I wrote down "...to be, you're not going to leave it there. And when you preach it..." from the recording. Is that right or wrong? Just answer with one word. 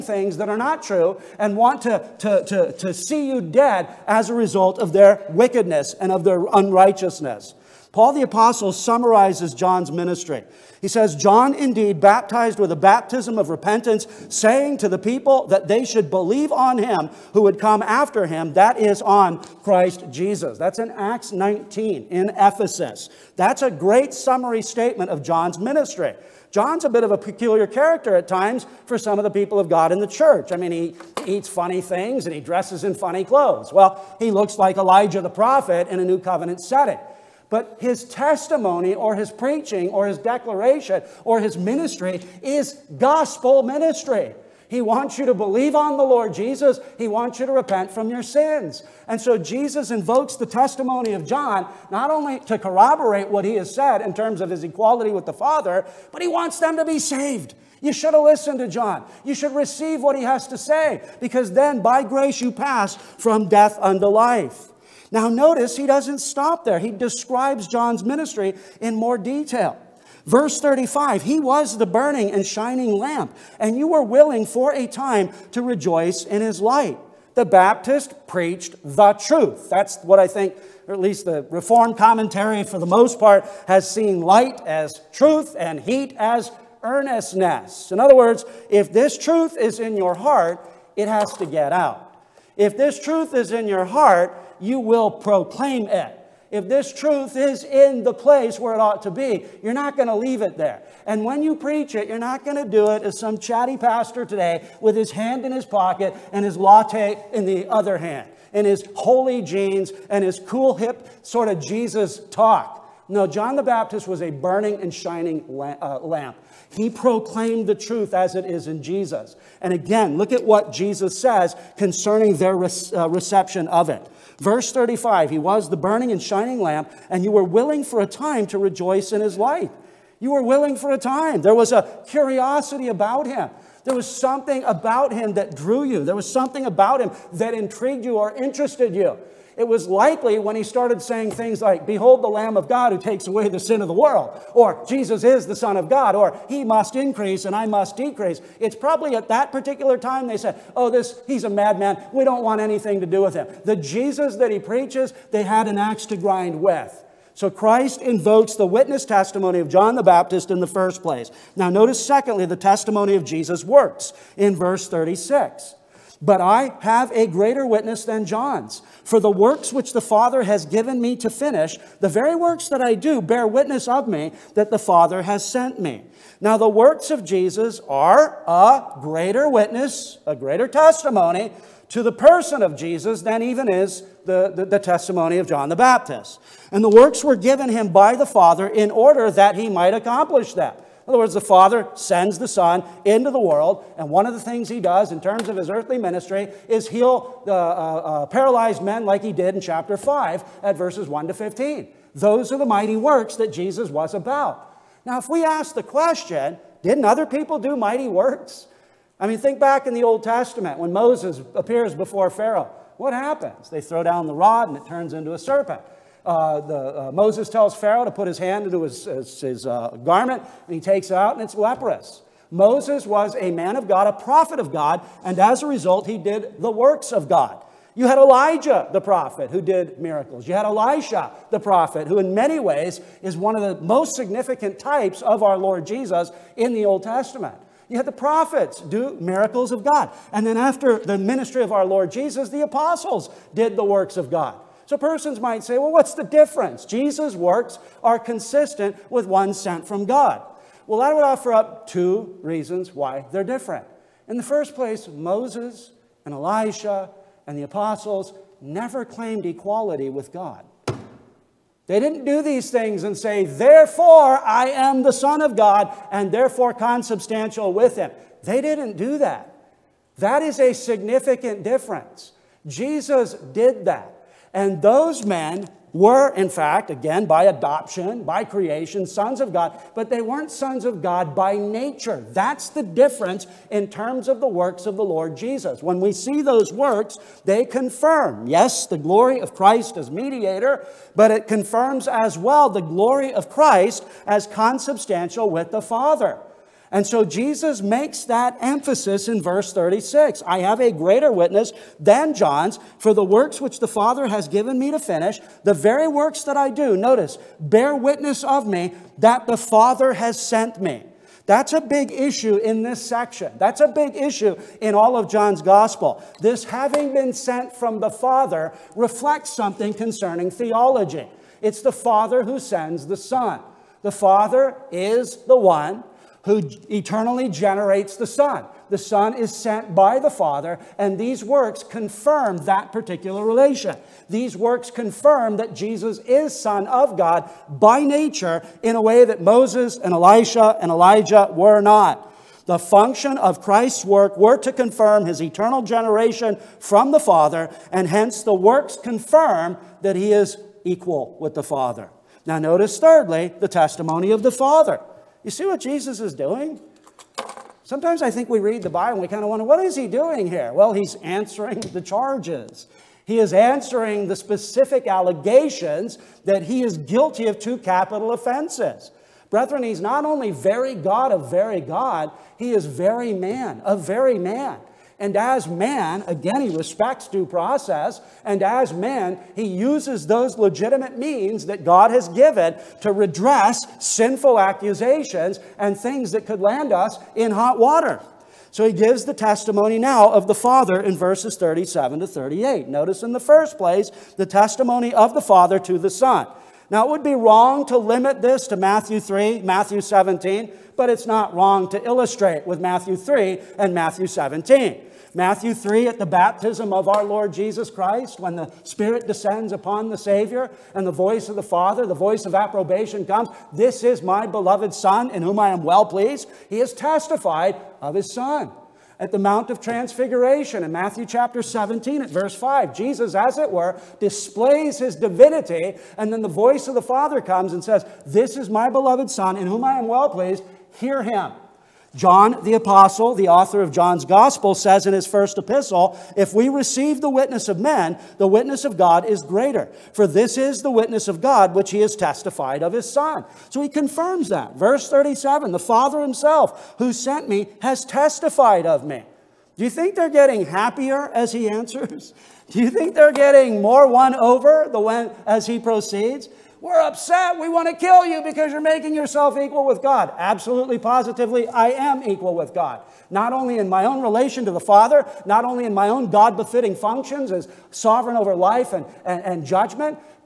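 right.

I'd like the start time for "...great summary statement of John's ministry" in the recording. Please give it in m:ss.
0:23.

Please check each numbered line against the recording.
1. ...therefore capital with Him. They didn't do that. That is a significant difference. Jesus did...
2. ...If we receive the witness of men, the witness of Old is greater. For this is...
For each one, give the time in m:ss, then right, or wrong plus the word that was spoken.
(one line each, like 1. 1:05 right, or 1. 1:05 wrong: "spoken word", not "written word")
1. 4:26 wrong: "consubstantial", not "capital"
2. 7:16 wrong: "God", not "Old".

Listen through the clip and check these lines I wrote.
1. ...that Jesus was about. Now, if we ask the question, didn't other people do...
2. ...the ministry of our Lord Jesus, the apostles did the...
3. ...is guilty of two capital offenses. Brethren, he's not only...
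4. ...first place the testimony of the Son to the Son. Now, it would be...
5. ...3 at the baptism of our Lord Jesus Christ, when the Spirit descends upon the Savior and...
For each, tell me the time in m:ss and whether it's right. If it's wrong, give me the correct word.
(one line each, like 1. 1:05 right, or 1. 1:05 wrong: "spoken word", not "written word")
1. 3:23 right
2. 4:00 right
3. 6:06 right
4. 6:33 wrong: "Father", not "Son"
5. 6:45 right.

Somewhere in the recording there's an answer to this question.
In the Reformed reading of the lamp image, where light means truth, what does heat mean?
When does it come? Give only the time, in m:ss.
1:26.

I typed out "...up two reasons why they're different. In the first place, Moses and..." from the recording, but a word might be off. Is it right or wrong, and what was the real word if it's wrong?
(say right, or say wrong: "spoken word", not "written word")
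right.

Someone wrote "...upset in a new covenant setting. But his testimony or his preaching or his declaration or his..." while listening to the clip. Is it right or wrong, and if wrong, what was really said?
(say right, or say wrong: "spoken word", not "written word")
wrong: "prophet", not "upset".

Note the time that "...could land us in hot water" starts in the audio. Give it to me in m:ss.
6:26.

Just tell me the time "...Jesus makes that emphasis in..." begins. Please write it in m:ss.
4:57.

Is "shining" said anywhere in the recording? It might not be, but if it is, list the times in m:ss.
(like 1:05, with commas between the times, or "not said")
1:12, 1:54, 2:06.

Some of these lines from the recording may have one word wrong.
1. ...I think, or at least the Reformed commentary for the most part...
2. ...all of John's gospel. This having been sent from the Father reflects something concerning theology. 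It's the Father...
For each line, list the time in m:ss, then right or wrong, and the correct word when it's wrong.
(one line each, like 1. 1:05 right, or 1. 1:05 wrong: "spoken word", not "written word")
1. 1:20 right
2. 5:14 right.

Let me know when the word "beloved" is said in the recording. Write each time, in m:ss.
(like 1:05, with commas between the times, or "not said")
6:54, 7:08.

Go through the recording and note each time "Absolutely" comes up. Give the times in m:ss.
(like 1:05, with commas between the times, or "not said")
7:40.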